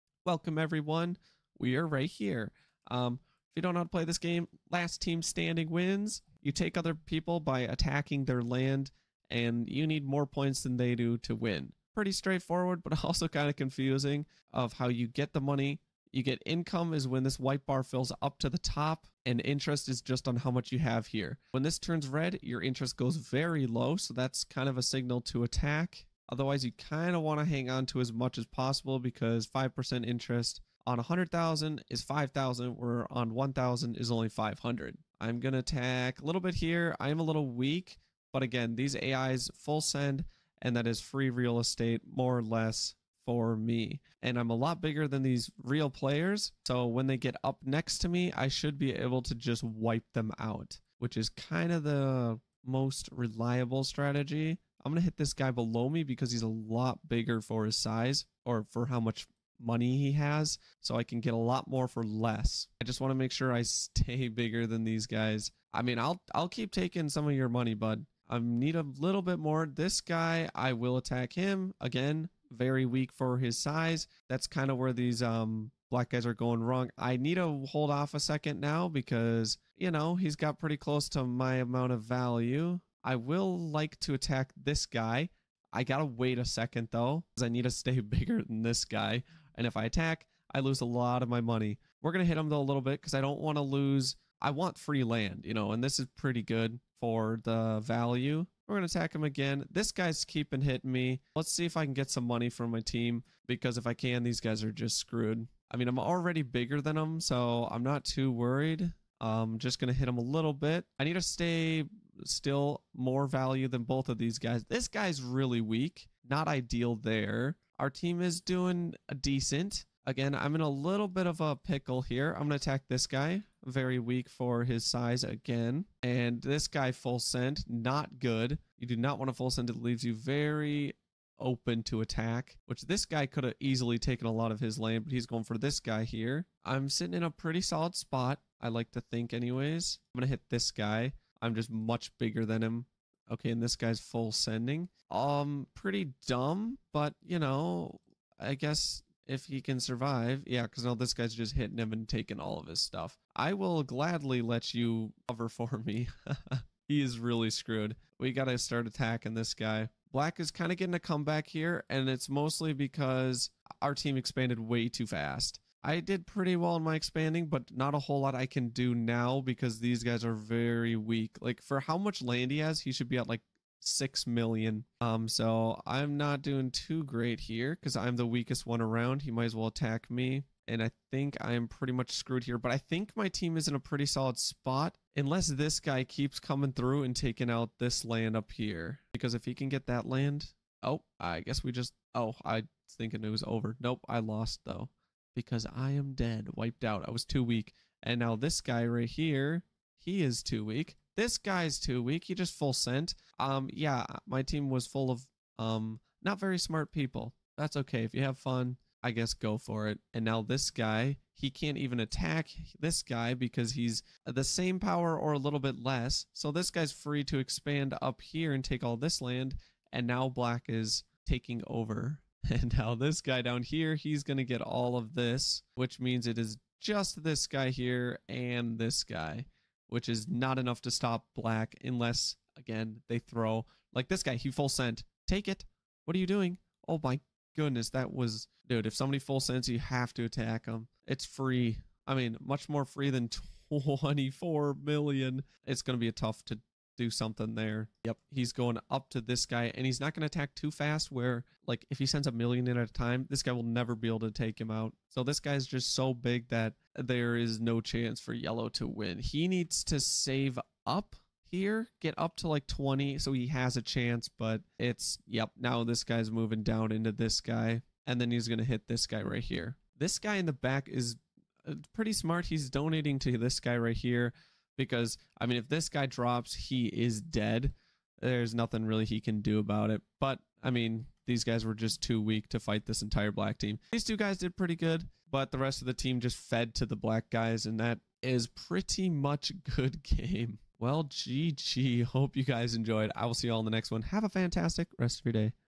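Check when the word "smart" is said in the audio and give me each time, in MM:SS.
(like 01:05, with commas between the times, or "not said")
03:26, 04:32.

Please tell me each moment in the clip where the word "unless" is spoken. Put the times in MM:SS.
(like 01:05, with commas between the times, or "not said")
03:05, 03:51.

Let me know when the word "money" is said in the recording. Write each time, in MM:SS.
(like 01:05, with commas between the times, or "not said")
00:15, 00:59, 01:07, 01:31, 01:42.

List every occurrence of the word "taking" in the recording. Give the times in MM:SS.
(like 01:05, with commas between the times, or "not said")
01:06, 02:32, 03:07, 03:41.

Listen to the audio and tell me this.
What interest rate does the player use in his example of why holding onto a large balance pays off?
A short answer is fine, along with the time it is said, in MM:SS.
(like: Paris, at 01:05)
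5%, at 00:29.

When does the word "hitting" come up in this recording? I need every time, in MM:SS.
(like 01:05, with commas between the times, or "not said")
01:40, 02:31.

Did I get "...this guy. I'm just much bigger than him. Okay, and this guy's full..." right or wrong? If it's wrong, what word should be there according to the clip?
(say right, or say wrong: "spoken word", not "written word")
right.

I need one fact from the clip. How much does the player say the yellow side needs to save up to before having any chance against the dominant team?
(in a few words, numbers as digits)
20.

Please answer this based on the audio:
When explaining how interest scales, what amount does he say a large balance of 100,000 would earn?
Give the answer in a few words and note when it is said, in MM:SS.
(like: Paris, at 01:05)
5,000, at 00:32.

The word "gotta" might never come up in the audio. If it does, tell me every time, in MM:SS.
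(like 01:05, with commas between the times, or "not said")
01:25, 02:38.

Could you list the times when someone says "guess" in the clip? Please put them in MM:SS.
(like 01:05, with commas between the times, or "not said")
02:28, 03:11, 03:29.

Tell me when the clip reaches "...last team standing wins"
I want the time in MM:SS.
00:04.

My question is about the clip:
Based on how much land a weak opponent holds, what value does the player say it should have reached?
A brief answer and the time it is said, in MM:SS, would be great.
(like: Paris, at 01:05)
6 million, at 02:53.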